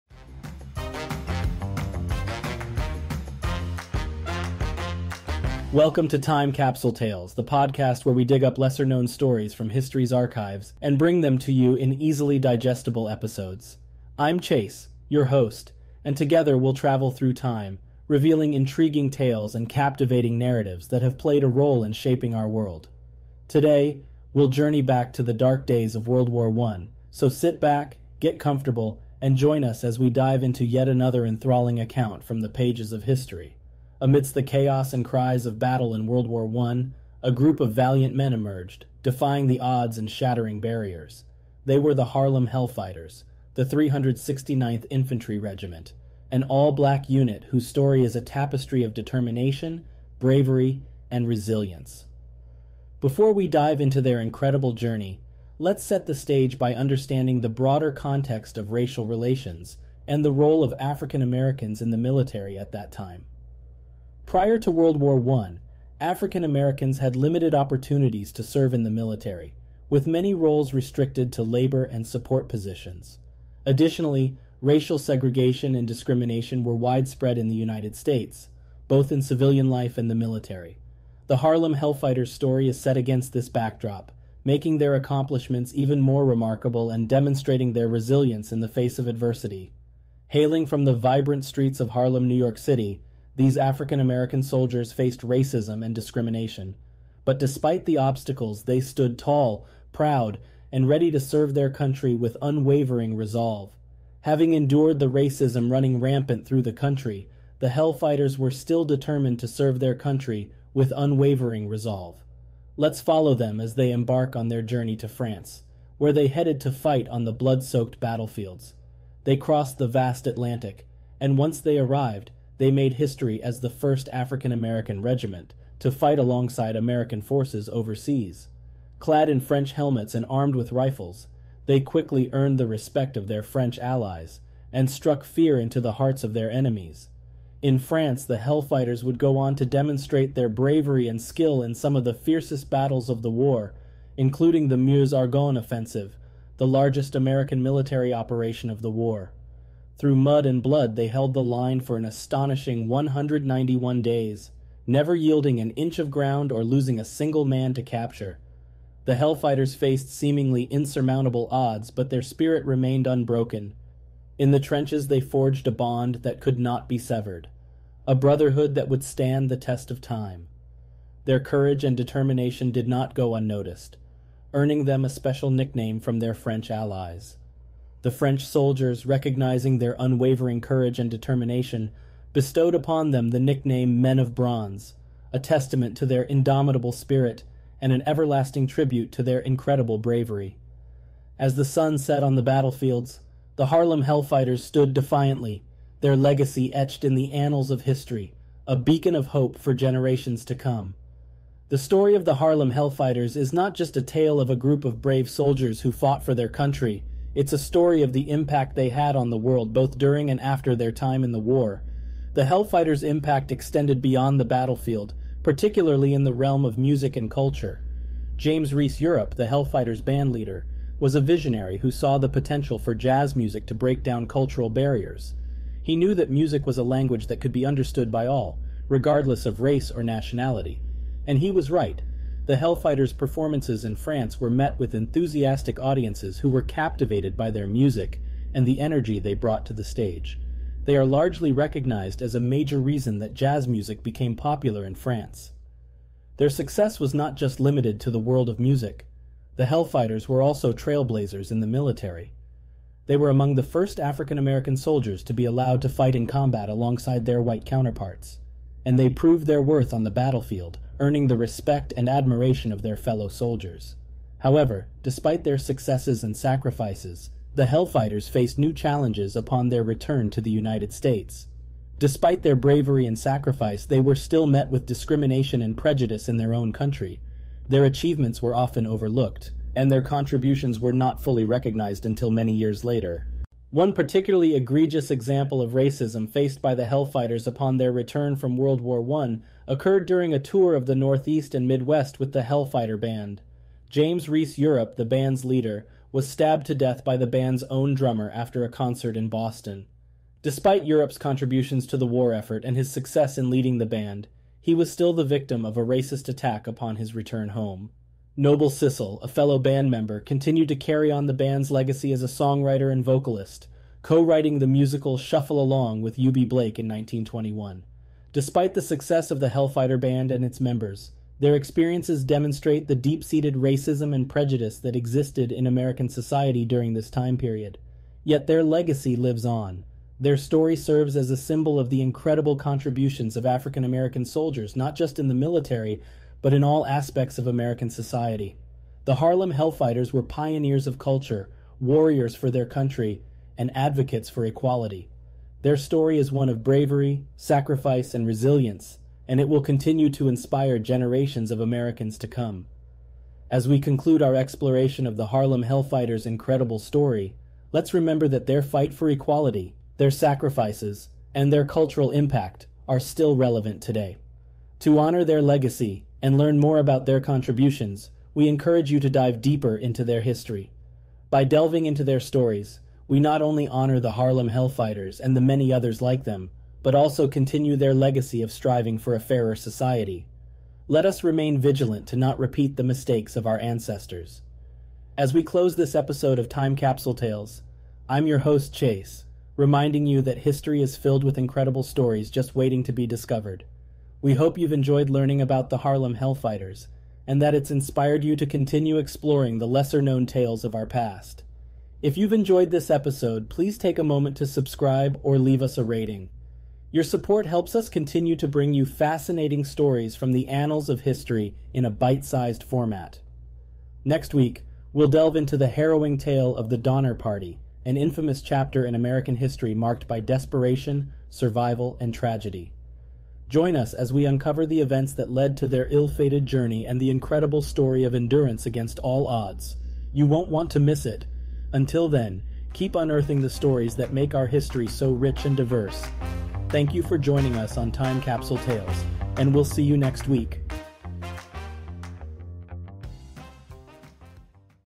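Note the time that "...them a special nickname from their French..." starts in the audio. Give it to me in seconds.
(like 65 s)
174 s.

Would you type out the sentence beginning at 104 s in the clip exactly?
Having endured the racism running rampant through the country, the Hellfighters were still determined to serve their country with unwavering resolve.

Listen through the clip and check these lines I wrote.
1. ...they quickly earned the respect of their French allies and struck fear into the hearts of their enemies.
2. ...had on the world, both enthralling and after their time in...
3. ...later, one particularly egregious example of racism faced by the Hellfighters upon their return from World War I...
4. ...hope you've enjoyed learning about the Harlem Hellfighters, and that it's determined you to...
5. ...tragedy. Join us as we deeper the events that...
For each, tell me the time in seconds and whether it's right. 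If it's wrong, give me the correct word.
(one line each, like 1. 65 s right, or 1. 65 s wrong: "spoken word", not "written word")
1. 131 s right
2. 208 s wrong: "during", not "enthralling"
3. 282 s right
4. 394 s wrong: "inspired", not "determined"
5. 422 s wrong: "uncover", not "deeper".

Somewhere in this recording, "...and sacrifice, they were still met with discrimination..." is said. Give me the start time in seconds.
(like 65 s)
273 s.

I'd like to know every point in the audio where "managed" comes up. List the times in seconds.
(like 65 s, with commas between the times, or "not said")
not said.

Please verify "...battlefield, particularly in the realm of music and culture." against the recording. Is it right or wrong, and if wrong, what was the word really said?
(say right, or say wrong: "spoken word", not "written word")
right.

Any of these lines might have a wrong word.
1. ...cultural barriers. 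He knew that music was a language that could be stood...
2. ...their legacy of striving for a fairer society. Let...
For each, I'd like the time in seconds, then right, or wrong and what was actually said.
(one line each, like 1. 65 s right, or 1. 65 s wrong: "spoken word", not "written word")
1. 224 s wrong: "understood", not "stood"
2. 377 s right.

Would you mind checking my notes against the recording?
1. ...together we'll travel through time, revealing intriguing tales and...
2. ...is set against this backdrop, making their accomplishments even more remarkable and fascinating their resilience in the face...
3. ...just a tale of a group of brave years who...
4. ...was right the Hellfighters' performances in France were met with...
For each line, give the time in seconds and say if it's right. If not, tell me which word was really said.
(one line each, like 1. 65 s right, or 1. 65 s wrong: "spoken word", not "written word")
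1. 16 s right
2. 82 s wrong: "demonstrating", not "fascinating"
3. 203 s wrong: "soldiers", not "years"
4. 231 s right.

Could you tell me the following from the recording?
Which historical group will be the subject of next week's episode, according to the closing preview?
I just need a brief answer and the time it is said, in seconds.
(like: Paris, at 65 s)
Donner Party, at 416 s.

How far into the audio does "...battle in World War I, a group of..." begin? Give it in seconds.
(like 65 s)
35 s.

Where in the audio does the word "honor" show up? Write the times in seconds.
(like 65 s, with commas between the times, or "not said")
364 s, 373 s.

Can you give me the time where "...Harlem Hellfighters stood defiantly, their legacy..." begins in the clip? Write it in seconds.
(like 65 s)
193 s.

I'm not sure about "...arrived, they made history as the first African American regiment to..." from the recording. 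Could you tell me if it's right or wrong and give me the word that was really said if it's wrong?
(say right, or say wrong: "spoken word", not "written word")
right.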